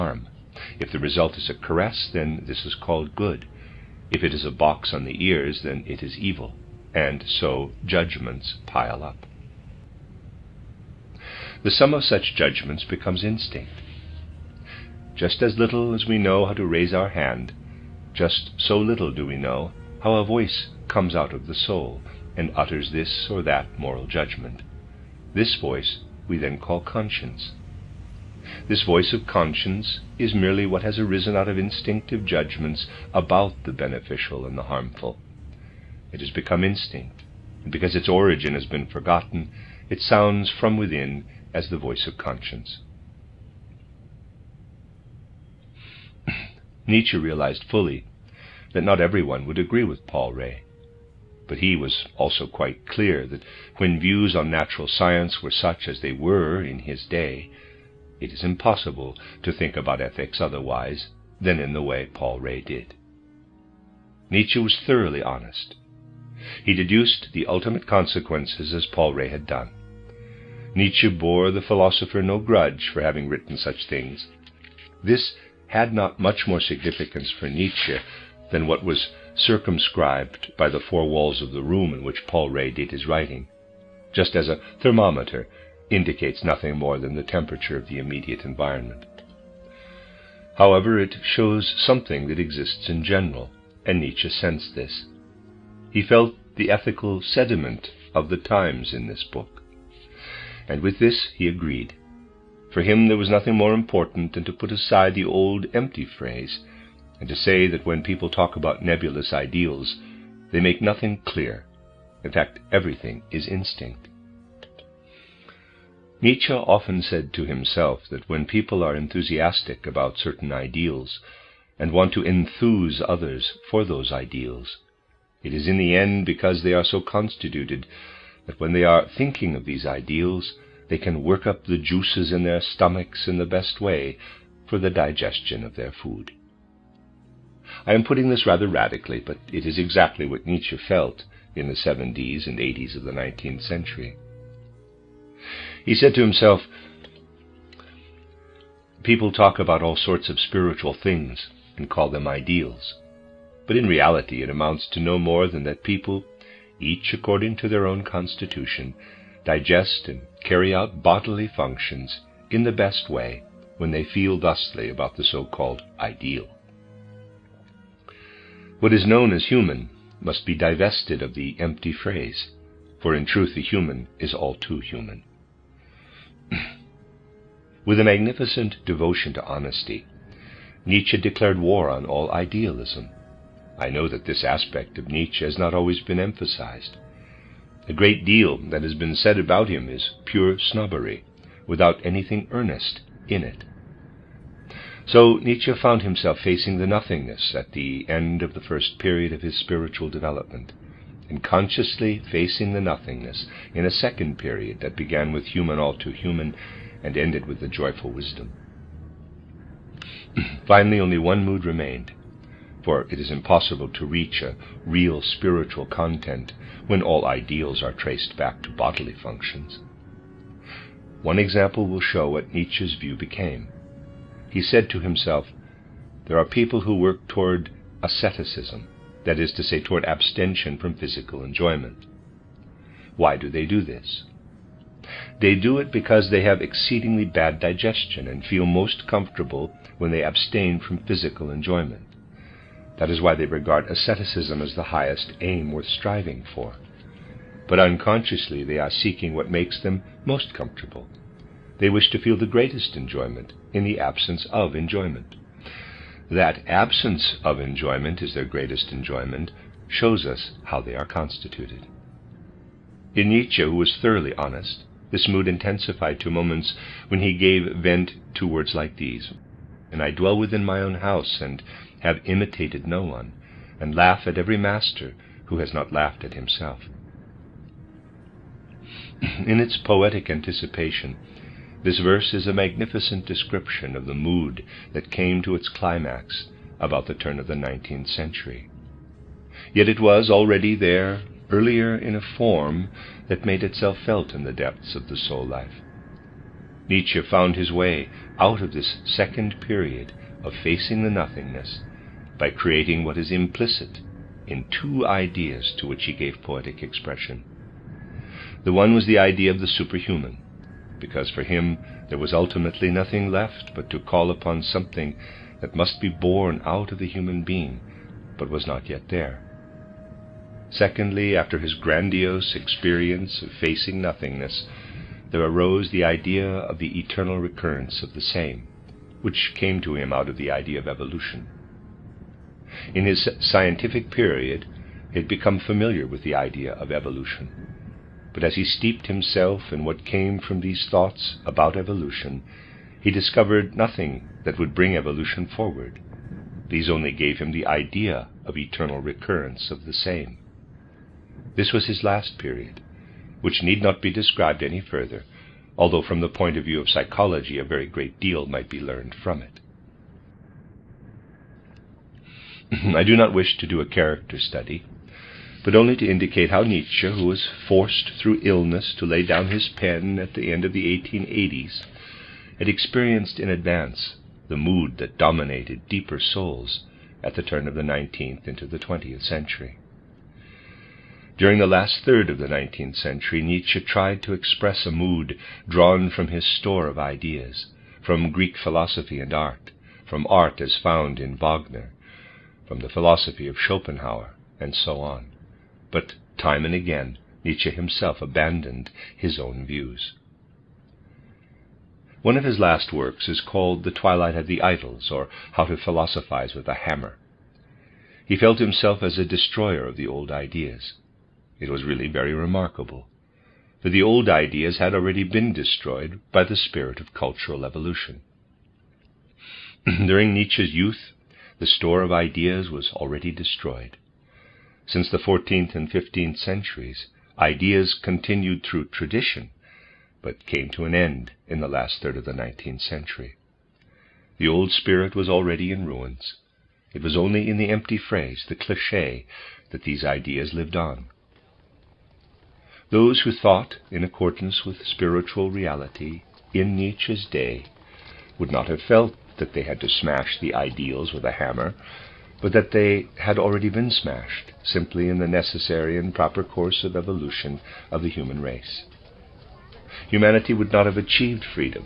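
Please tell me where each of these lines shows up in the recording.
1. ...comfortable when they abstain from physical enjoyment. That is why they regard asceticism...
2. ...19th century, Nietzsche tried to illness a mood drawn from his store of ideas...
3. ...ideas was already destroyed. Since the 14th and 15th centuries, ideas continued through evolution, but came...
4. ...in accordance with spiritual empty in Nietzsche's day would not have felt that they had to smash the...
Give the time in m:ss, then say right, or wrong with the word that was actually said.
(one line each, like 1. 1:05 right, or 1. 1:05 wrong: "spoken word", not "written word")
1. 3:59 right
2. 6:22 wrong: "express", not "illness"
3. 7:02 wrong: "tradition", not "evolution"
4. 7:23 wrong: "reality", not "empty".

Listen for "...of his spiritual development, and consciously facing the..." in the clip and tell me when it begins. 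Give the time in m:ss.
3:19.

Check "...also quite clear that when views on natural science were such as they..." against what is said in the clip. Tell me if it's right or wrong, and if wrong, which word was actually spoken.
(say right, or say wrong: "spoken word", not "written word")
right.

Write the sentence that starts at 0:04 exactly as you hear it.
If it is a box on the ears, then it is evil.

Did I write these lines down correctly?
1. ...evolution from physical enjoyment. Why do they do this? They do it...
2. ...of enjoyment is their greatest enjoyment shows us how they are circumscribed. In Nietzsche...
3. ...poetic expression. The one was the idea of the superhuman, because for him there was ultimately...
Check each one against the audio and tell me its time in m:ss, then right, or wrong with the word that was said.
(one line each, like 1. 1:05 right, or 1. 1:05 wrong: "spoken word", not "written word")
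1. 3:50 wrong: "abstention", not "evolution"
2. 4:17 wrong: "constituted", not "circumscribed"
3. 5:06 right.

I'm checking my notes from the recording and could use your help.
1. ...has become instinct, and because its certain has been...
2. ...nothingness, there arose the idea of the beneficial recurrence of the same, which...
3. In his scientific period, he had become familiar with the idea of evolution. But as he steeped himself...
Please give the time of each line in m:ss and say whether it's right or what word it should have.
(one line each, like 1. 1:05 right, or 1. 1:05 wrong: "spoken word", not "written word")
1. 0:36 wrong: "origin", not "certain"
2. 5:24 wrong: "eternal", not "beneficial"
3. 5:32 right.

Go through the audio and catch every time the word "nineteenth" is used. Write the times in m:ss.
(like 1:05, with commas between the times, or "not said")
4:47.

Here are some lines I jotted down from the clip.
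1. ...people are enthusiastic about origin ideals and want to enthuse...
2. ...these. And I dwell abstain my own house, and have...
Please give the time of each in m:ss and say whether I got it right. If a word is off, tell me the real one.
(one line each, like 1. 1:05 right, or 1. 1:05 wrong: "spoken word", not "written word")
1. 1:58 wrong: "certain", not "origin"
2. 4:28 wrong: "within", not "abstain".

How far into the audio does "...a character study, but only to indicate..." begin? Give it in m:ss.
6:03.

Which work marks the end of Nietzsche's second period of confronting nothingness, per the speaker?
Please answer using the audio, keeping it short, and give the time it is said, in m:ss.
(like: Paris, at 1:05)
The Joyful Wisdom, at 3:27.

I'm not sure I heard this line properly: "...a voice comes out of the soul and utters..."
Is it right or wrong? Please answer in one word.
right.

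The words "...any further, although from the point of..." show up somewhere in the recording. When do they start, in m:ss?
5:54.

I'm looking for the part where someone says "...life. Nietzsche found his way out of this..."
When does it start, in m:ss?
4:55.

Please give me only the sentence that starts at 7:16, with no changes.
It was only in the empty phrase, the cliché, that these ideas lived on.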